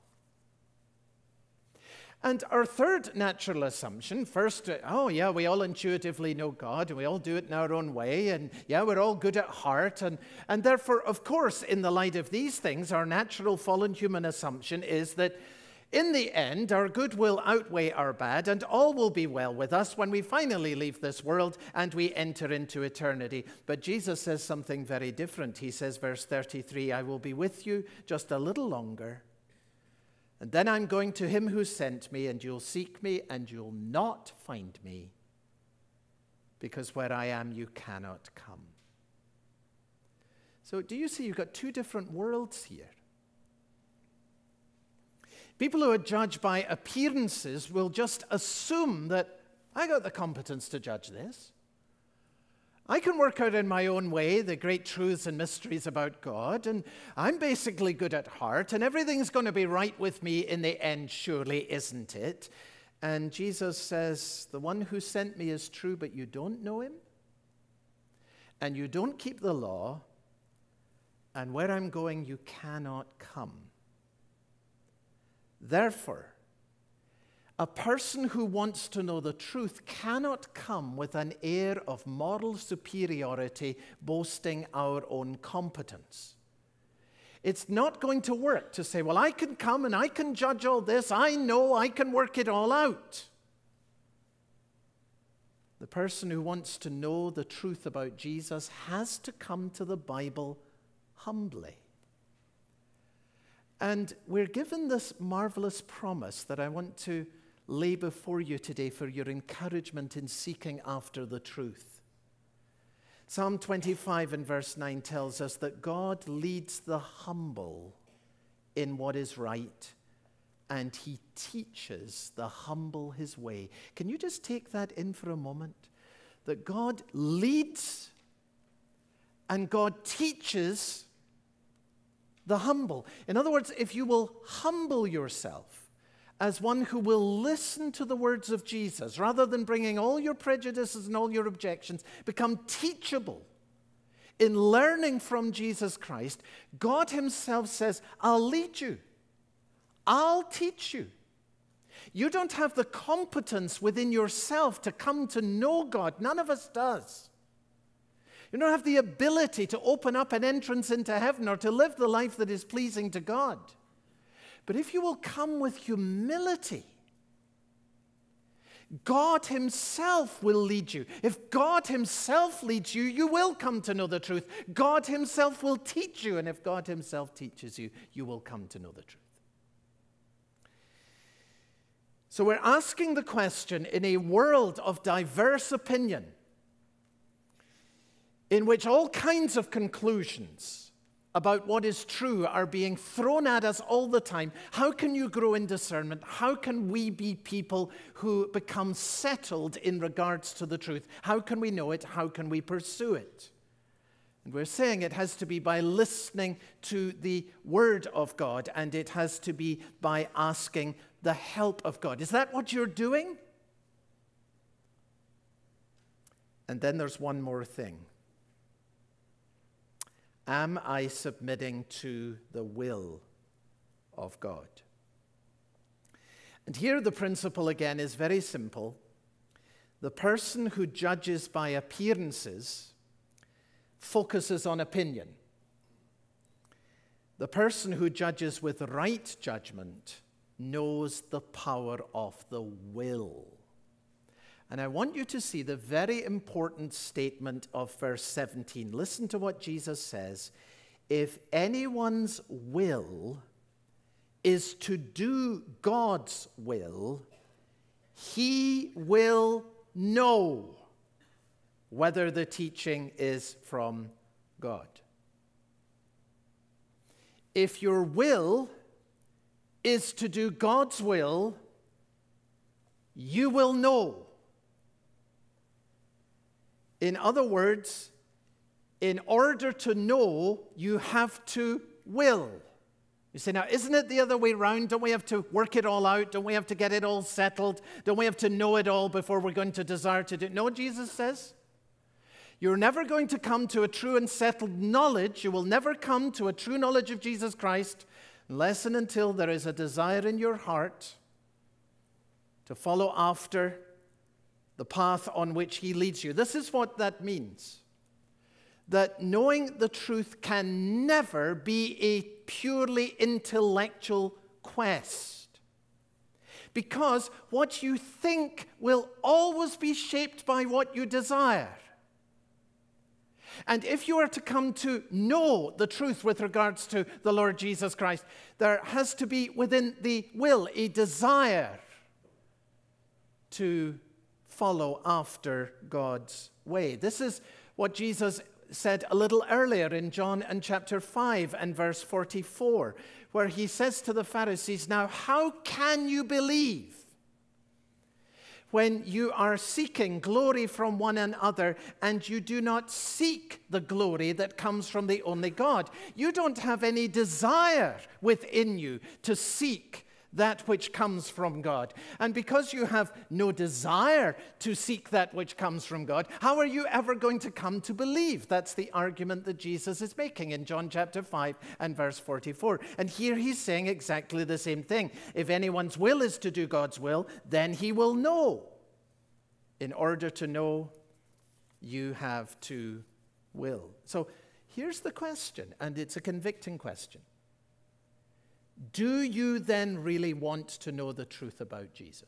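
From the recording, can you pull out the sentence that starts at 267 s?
If your will is to do God's will, you will know in other words, in order to know, you have to will.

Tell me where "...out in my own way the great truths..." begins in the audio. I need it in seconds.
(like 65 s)
53 s.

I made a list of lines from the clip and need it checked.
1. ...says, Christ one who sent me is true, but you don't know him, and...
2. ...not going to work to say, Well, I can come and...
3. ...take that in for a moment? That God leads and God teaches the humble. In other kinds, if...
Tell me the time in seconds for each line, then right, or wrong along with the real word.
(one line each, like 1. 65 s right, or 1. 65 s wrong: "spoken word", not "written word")
1. 63 s wrong: "The", not "Christ"
2. 87 s right
3. 124 s wrong: "words", not "kinds".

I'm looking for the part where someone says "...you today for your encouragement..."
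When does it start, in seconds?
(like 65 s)
108 s.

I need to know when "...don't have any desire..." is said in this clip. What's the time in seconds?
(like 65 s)
356 s.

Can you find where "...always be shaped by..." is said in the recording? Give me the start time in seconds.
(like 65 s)
319 s.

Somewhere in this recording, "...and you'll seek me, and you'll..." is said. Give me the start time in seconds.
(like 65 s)
32 s.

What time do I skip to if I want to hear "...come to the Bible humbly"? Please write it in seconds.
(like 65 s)
99 s.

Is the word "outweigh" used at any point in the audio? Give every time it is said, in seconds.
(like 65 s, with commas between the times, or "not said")
17 s.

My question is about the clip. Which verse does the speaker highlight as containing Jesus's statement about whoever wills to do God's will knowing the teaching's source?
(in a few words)
Verse 17.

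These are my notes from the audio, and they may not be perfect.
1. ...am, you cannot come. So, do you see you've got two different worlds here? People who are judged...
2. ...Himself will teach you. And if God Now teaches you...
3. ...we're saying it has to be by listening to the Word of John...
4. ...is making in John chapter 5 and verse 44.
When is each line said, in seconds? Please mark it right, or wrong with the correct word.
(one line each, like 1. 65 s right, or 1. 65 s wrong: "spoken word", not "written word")
1. 37 s right
2. 175 s wrong: "Himself", not "Now"
3. 204 s wrong: "God", not "John"
4. 370 s right.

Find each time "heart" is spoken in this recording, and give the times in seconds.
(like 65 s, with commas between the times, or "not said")
9 s, 58 s, 300 s.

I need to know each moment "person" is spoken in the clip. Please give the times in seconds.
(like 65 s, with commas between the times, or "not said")
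77 s, 95 s, 230 s, 237 s.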